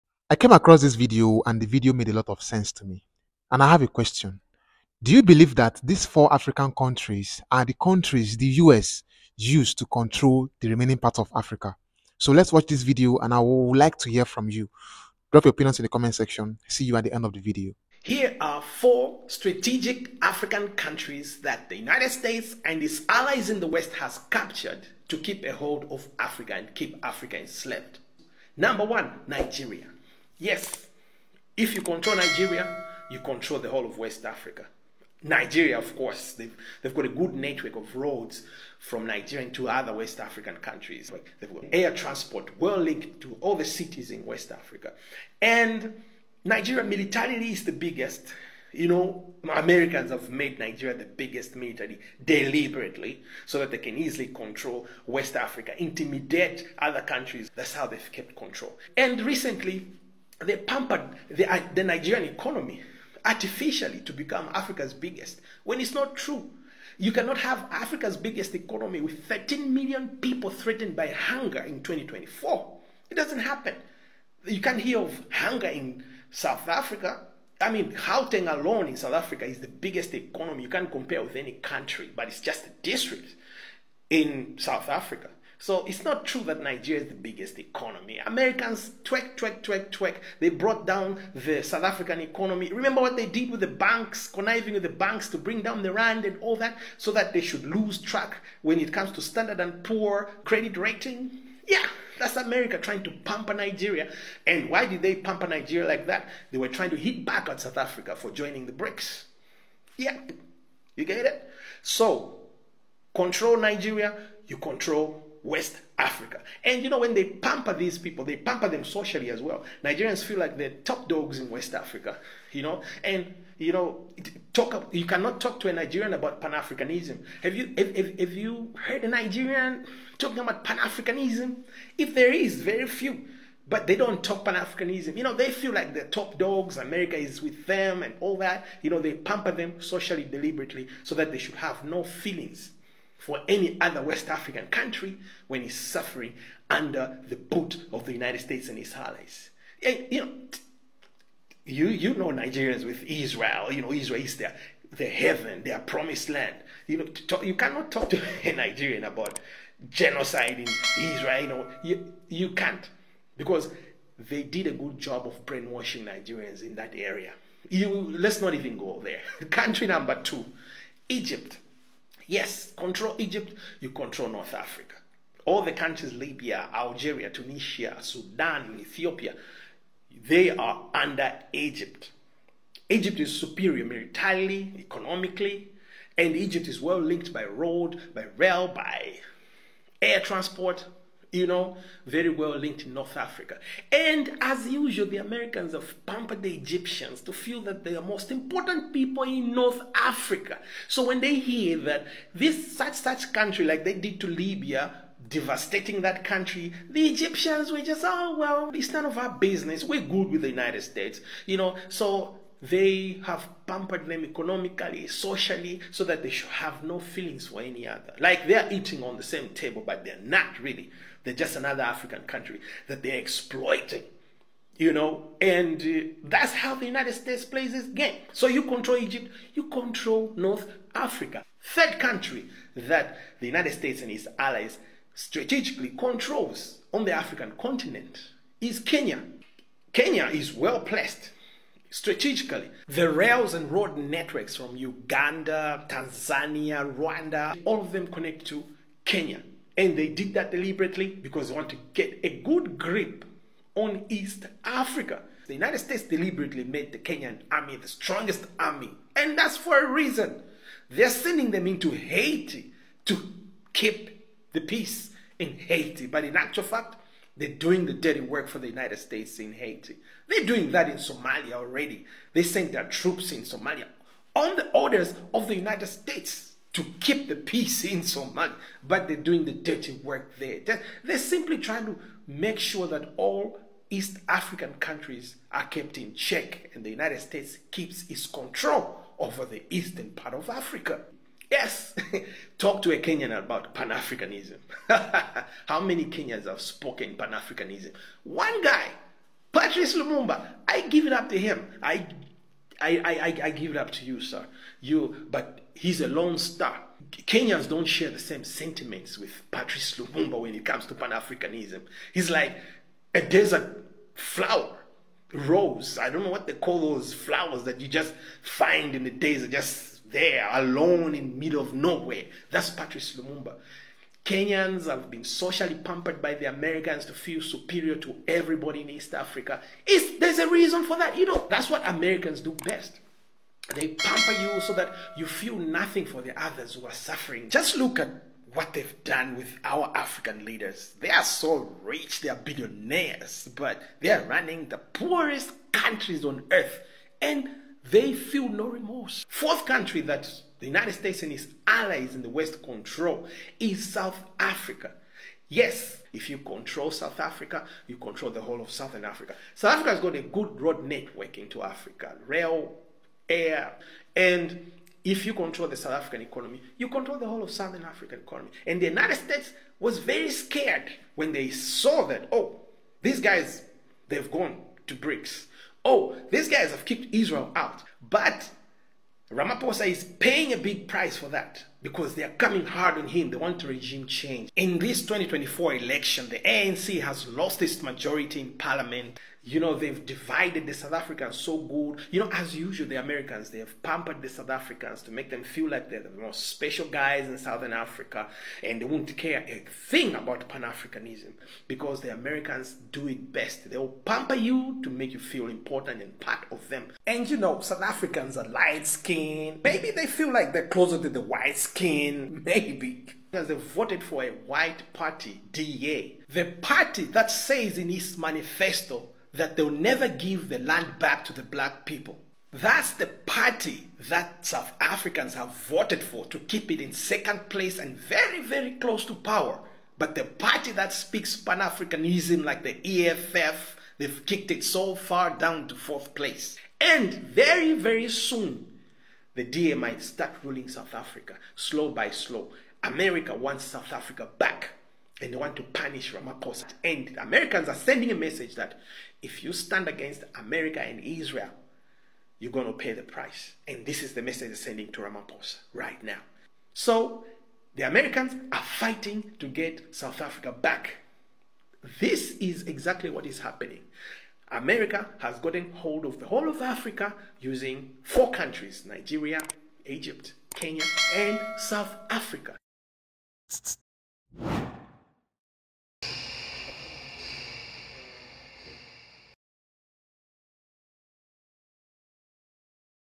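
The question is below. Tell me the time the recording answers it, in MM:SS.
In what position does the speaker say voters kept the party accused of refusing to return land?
07:06.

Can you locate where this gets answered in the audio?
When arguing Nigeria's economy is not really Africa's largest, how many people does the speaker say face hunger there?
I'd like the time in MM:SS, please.
01:09.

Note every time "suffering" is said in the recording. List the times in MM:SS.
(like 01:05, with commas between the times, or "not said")
02:25, 05:36.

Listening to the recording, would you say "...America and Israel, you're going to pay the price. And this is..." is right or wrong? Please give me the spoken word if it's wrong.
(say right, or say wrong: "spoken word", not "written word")
right.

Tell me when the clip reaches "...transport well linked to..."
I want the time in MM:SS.
00:41.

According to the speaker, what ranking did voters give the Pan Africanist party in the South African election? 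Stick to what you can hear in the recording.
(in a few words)
fourth place.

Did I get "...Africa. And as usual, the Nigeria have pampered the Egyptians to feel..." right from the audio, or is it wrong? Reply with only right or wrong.
wrong.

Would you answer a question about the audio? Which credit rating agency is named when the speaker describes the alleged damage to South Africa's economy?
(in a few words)
Standard and Poor.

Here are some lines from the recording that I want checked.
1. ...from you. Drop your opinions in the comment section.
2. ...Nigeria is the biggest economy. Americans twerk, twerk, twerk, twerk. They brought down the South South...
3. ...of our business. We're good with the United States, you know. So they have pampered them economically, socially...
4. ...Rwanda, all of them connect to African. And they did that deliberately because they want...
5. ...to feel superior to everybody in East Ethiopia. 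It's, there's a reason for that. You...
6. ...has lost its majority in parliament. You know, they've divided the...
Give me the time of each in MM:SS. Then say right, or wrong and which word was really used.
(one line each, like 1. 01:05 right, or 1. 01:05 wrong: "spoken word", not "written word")
1. 00:14 right
2. 01:26 wrong: "African", not "South"
3. 03:29 right
4. 04:06 wrong: "Kenya", not "African"
5. 05:27 wrong: "Africa", not "Ethiopia"
6. 06:27 right.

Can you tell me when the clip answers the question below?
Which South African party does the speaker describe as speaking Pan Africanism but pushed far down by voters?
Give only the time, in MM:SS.
07:13.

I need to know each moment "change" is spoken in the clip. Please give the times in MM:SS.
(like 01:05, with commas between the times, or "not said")
06:24.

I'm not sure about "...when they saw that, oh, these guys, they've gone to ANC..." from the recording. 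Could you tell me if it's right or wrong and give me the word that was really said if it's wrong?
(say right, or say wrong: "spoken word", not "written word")
wrong: "BRICS", not "ANC".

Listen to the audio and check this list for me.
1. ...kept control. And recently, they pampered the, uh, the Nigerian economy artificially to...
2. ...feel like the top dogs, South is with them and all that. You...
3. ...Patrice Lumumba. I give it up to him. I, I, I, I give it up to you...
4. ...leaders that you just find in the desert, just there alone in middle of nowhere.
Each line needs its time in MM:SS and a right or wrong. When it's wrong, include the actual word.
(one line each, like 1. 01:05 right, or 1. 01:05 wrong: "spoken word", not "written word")
1. 00:58 right
2. 02:15 wrong: "America", not "South"
3. 04:59 right
4. 05:17 wrong: "flowers", not "leaders".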